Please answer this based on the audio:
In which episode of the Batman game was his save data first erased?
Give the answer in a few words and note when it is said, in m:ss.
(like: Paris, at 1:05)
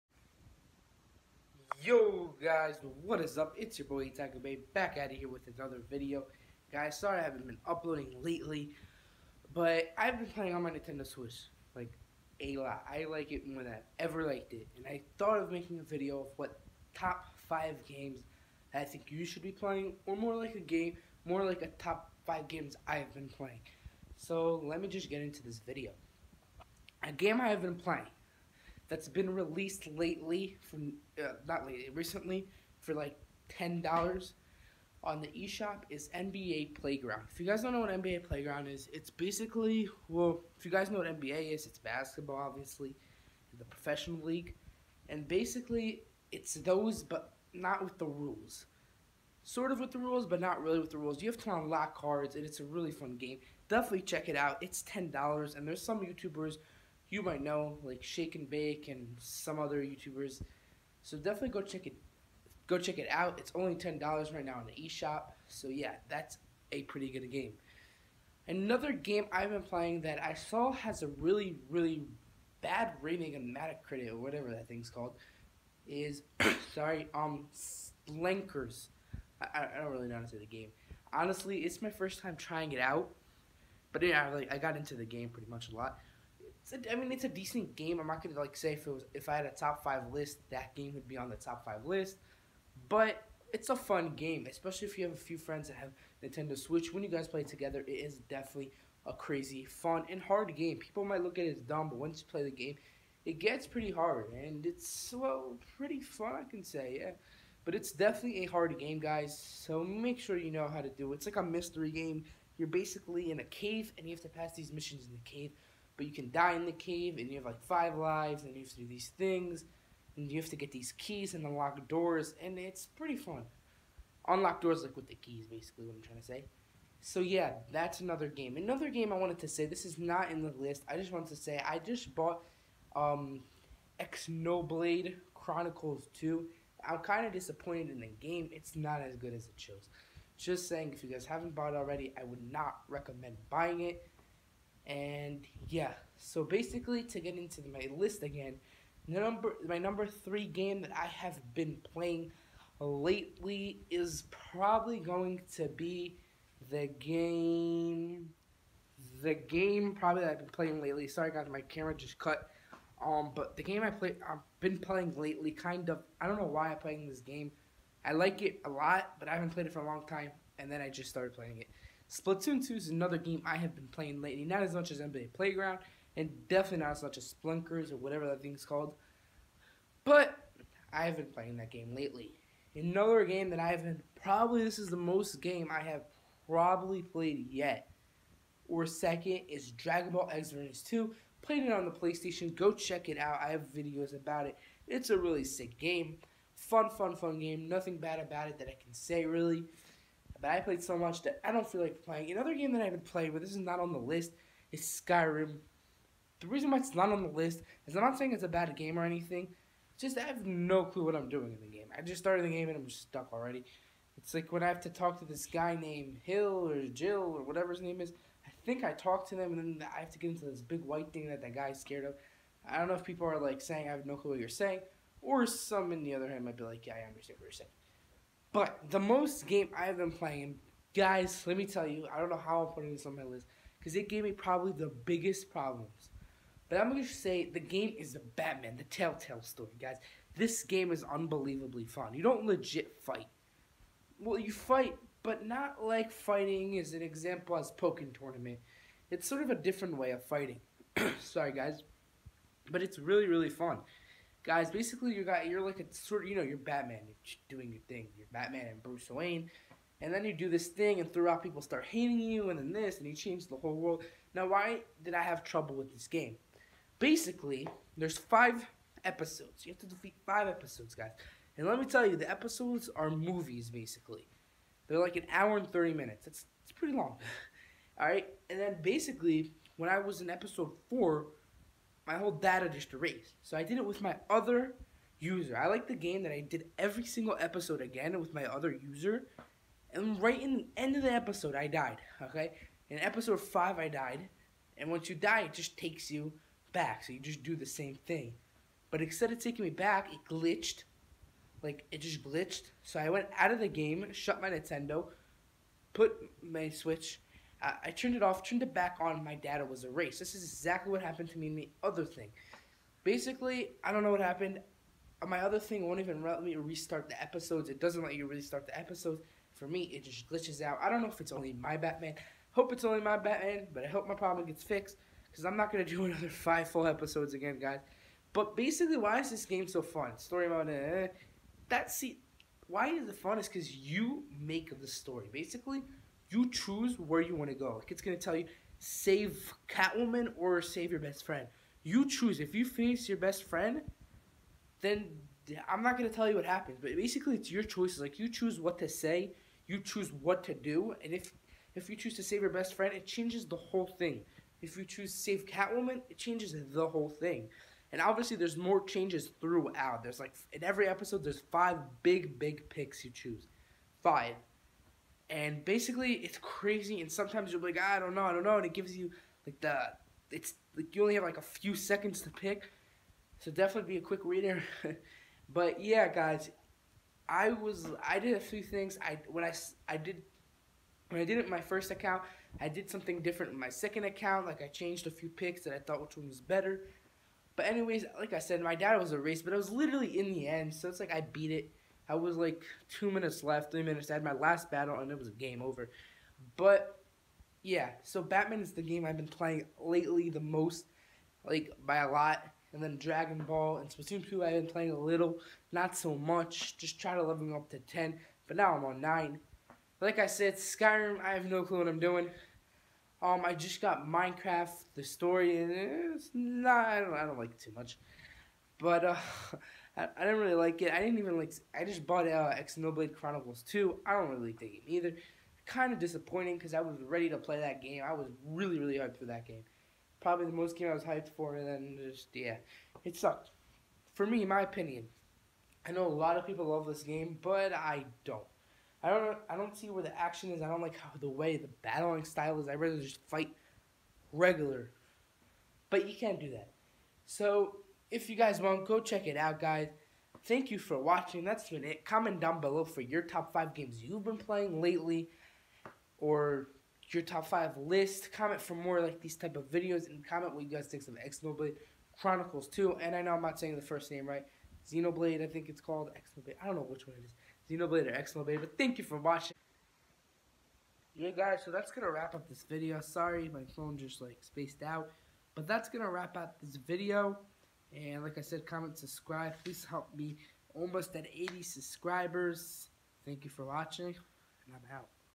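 episode 4, at 4:40.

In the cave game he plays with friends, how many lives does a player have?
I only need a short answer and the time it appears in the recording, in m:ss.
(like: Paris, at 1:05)
5, at 1:57.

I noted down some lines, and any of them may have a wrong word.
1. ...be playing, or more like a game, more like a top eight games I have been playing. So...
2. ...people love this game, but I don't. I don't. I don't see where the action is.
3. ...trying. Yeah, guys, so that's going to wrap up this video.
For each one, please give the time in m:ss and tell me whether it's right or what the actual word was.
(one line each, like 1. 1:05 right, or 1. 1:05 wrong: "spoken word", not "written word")
1. 0:19 wrong: "five", not "eight"
2. 7:16 right
3. 7:49 wrong: "watching", not "trying".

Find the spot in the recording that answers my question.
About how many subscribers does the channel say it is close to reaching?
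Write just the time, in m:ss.
8:01.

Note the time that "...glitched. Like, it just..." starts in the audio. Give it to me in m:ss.
5:00.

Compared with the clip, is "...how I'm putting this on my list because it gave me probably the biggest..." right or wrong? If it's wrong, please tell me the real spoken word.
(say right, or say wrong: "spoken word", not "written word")
right.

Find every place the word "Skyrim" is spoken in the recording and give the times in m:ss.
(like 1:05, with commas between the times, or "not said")
3:24, 6:50.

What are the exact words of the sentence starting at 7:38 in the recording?
Comment for more like these type of videos, and comment what you guys think of X Xenoblade Chronicles 2.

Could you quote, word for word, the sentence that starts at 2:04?
Unlock doors like with the keys, basically, what I'm trying to say.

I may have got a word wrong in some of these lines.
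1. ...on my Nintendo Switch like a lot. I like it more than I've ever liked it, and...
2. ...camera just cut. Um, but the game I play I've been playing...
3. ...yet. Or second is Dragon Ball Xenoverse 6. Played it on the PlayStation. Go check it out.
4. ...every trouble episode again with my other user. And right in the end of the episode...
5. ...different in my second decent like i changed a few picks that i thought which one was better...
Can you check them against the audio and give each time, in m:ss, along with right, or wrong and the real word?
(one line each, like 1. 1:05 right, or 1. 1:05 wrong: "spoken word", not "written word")
1. 0:10 right
2. 2:41 right
3. 3:07 wrong: "2", not "6"
4. 4:46 wrong: "single", not "trouble"
5. 6:23 wrong: "account", not "decent".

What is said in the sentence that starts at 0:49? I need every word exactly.
Sort of with the rules, but not really with the rules.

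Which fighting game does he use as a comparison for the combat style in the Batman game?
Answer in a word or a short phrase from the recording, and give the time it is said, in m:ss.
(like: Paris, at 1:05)
Pokken Tournament, at 4:07.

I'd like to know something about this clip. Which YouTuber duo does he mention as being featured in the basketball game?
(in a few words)
Shake and Bake.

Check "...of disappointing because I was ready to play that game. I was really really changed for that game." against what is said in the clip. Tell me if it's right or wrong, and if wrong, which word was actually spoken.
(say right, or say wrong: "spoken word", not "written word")
wrong: "hyped", not "changed".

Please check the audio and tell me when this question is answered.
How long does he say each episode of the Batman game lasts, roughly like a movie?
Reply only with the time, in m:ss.
4:35.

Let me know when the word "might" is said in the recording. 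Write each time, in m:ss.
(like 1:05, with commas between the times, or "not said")
0:57, 1:41, 3:46.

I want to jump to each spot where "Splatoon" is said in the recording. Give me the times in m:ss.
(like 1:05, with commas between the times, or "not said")
2:52, 6:43.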